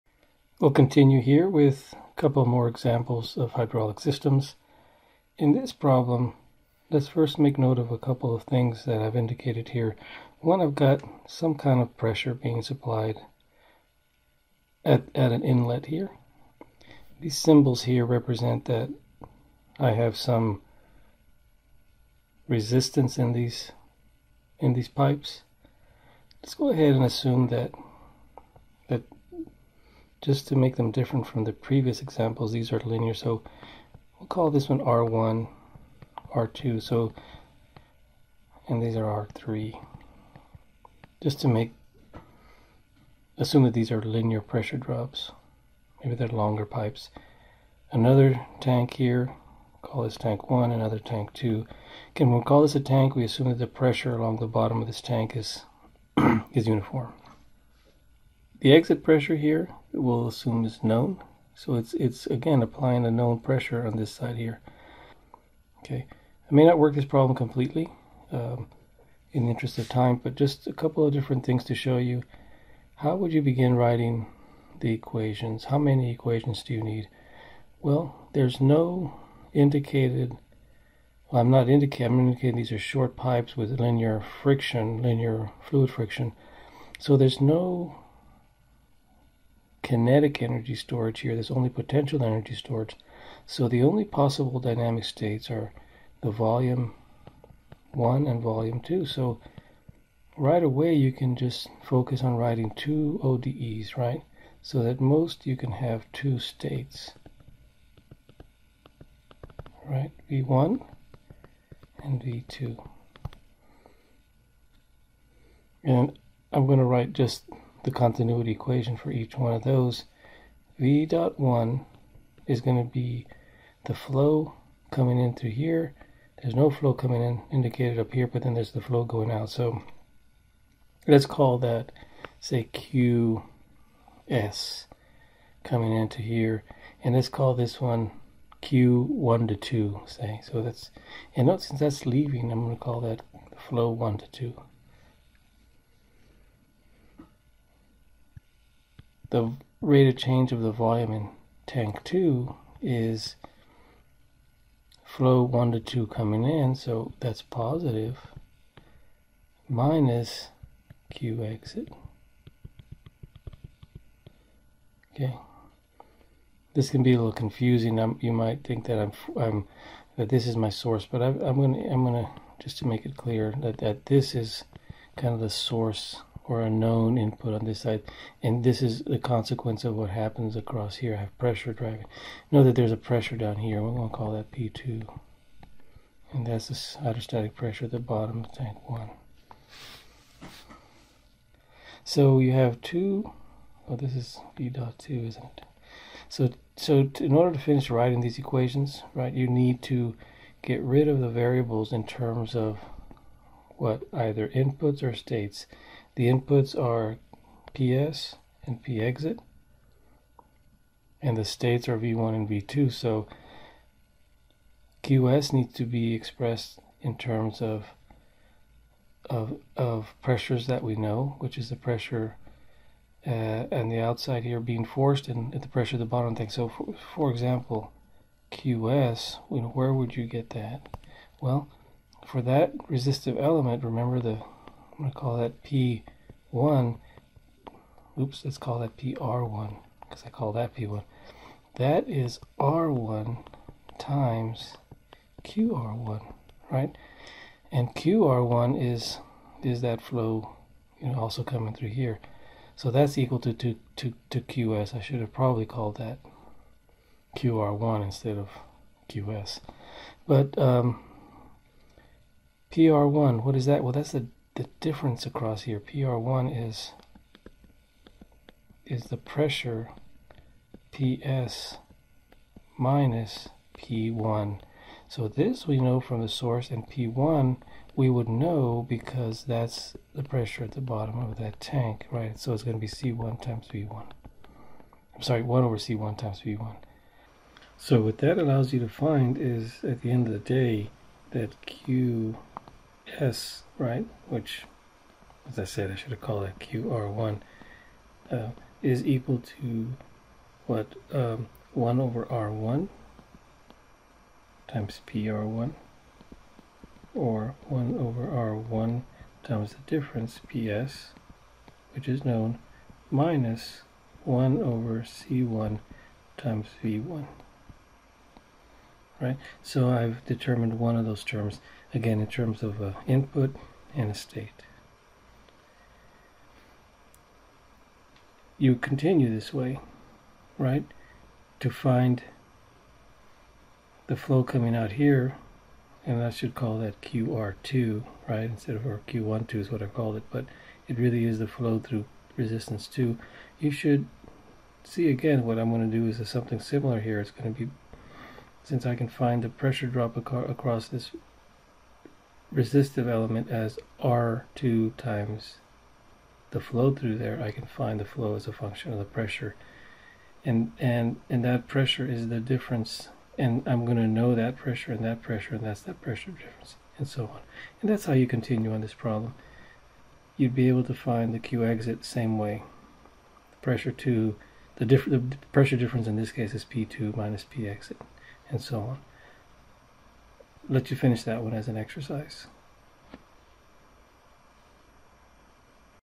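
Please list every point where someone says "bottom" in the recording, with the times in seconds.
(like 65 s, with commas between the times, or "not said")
54 s, 187 s, 226 s, 280 s.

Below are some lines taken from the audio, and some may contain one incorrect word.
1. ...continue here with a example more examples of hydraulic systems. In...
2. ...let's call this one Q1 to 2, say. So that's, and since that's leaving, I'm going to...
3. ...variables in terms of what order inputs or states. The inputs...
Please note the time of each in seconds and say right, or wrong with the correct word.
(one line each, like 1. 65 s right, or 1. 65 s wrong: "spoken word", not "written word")
1. 0 s wrong: "couple", not "example"
2. 137 s right
3. 201 s wrong: "either", not "order".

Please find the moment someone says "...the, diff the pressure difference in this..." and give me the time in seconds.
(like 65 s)
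374 s.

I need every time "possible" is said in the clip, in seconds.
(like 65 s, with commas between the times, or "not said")
94 s.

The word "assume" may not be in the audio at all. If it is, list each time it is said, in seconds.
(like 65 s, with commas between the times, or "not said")
27 s, 43 s, 53 s, 60 s.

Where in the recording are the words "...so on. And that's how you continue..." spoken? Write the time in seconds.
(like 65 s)
367 s.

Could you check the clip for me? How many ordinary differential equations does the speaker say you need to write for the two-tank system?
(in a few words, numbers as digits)
2.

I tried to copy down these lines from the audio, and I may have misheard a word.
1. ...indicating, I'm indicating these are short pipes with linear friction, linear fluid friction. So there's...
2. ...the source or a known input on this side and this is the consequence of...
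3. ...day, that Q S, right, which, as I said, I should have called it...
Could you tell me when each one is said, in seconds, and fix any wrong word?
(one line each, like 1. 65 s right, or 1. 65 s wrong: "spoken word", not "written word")
1. 81 s right
2. 175 s right
3. 290 s right.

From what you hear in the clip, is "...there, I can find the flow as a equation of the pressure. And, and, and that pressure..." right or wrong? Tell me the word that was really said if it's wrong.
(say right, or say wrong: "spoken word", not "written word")
wrong: "function", not "equation".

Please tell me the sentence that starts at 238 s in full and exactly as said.
Oops, let's call that PR1 because I call that P1.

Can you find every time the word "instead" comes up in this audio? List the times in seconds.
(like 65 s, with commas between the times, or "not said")
258 s, 338 s.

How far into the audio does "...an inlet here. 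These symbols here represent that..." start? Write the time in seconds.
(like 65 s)
15 s.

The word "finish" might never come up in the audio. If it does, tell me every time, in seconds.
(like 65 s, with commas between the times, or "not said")
197 s, 380 s.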